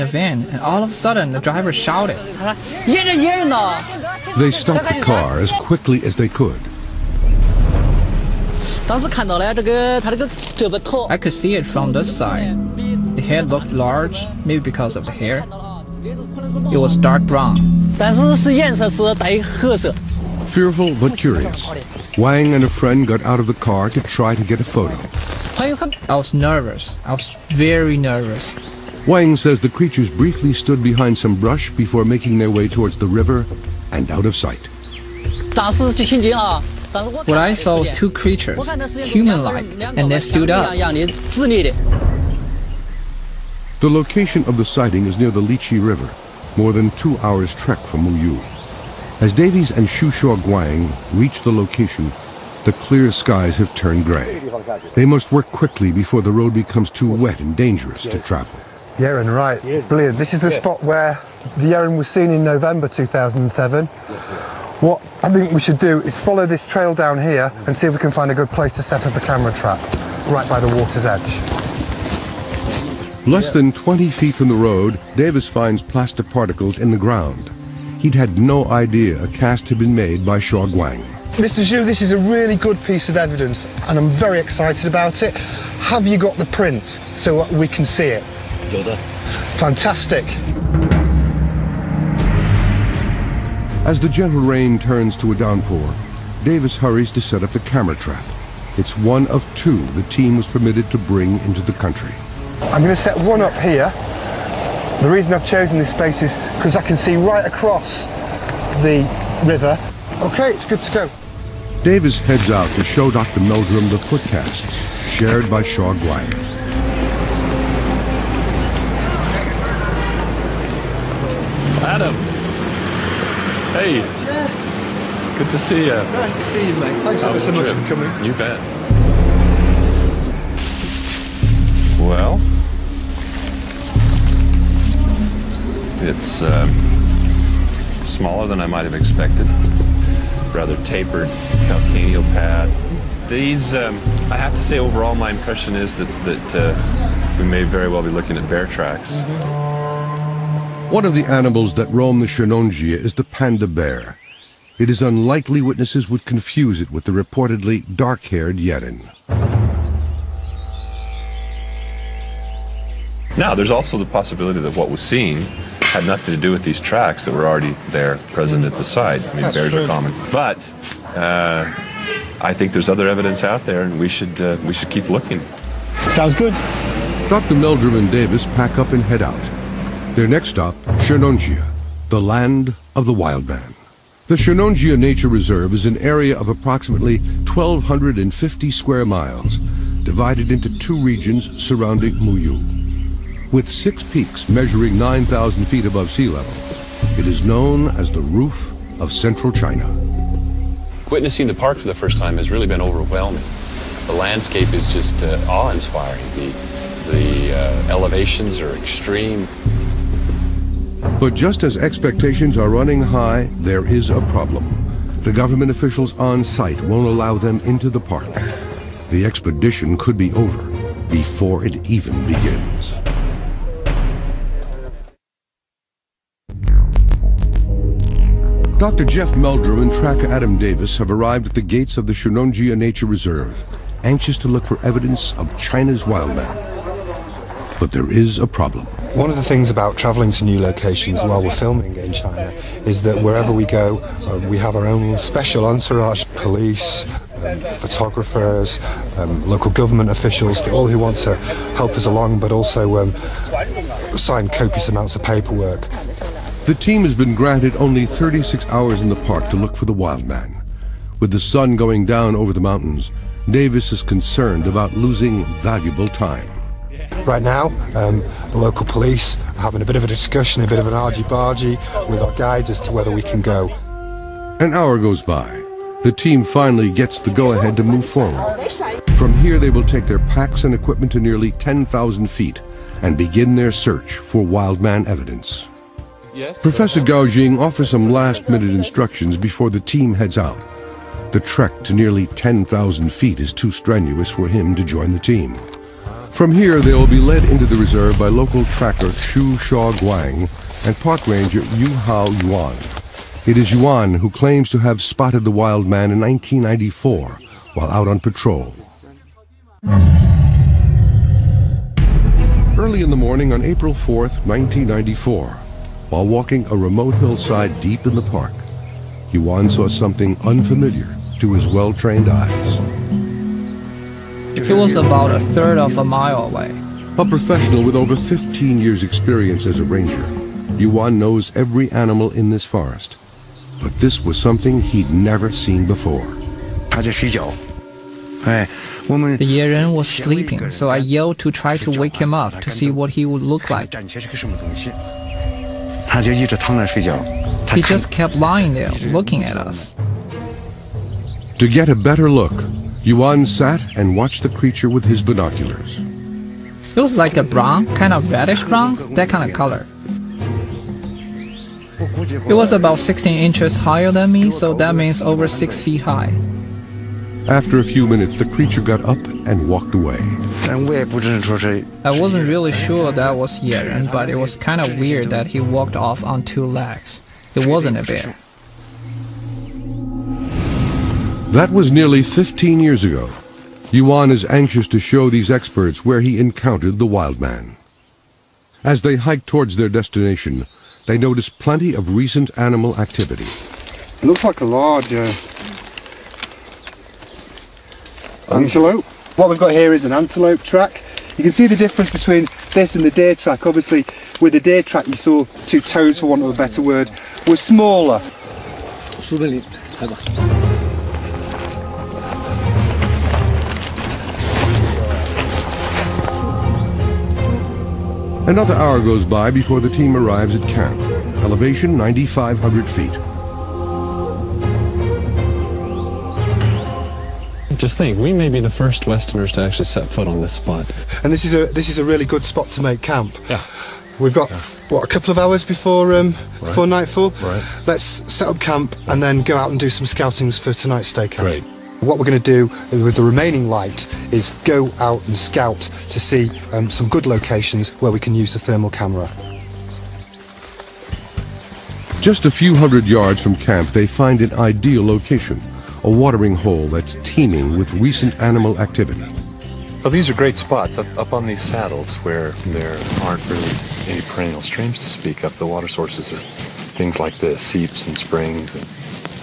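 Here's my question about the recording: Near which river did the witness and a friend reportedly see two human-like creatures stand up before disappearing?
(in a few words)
Lichi River.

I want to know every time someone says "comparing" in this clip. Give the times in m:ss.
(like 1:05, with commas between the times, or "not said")
not said.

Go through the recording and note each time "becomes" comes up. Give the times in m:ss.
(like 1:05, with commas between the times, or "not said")
0:56.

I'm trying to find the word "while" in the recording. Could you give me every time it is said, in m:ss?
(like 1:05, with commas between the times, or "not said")
4:01, 5:07, 5:16.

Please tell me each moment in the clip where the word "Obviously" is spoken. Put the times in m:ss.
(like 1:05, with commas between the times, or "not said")
6:43.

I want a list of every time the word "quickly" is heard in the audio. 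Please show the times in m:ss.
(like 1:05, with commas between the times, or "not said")
0:05, 0:55.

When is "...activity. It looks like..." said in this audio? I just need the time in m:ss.
6:32.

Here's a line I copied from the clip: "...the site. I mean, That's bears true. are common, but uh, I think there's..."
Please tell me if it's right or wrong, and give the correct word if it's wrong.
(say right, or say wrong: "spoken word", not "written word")
right.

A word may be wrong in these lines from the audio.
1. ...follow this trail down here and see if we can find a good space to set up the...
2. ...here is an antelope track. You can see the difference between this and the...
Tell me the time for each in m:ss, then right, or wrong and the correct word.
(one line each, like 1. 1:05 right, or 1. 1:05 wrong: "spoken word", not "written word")
1. 1:06 wrong: "place", not "space"
2. 6:39 right.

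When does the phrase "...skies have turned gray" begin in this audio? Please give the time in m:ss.
0:53.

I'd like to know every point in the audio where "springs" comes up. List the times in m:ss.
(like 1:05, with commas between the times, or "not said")
7:48.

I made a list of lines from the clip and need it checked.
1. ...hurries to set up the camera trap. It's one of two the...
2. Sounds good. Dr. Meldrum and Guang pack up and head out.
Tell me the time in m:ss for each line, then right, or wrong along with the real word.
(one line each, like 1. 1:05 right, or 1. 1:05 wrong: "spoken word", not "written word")
1. 1:36 right
2. 2:56 wrong: "Davies", not "Guang".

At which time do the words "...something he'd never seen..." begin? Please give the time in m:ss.
5:34.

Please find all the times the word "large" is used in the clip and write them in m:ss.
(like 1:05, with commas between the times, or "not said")
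0:13, 6:34.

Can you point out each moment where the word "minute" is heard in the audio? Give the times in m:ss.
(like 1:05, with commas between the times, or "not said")
4:48, 6:08.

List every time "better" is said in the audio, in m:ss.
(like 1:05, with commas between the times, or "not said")
5:51, 6:46.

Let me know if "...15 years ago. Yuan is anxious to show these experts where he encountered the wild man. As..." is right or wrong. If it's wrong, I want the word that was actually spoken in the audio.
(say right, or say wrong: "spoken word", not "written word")
right.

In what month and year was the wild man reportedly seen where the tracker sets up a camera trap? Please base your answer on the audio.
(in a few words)
November 2007.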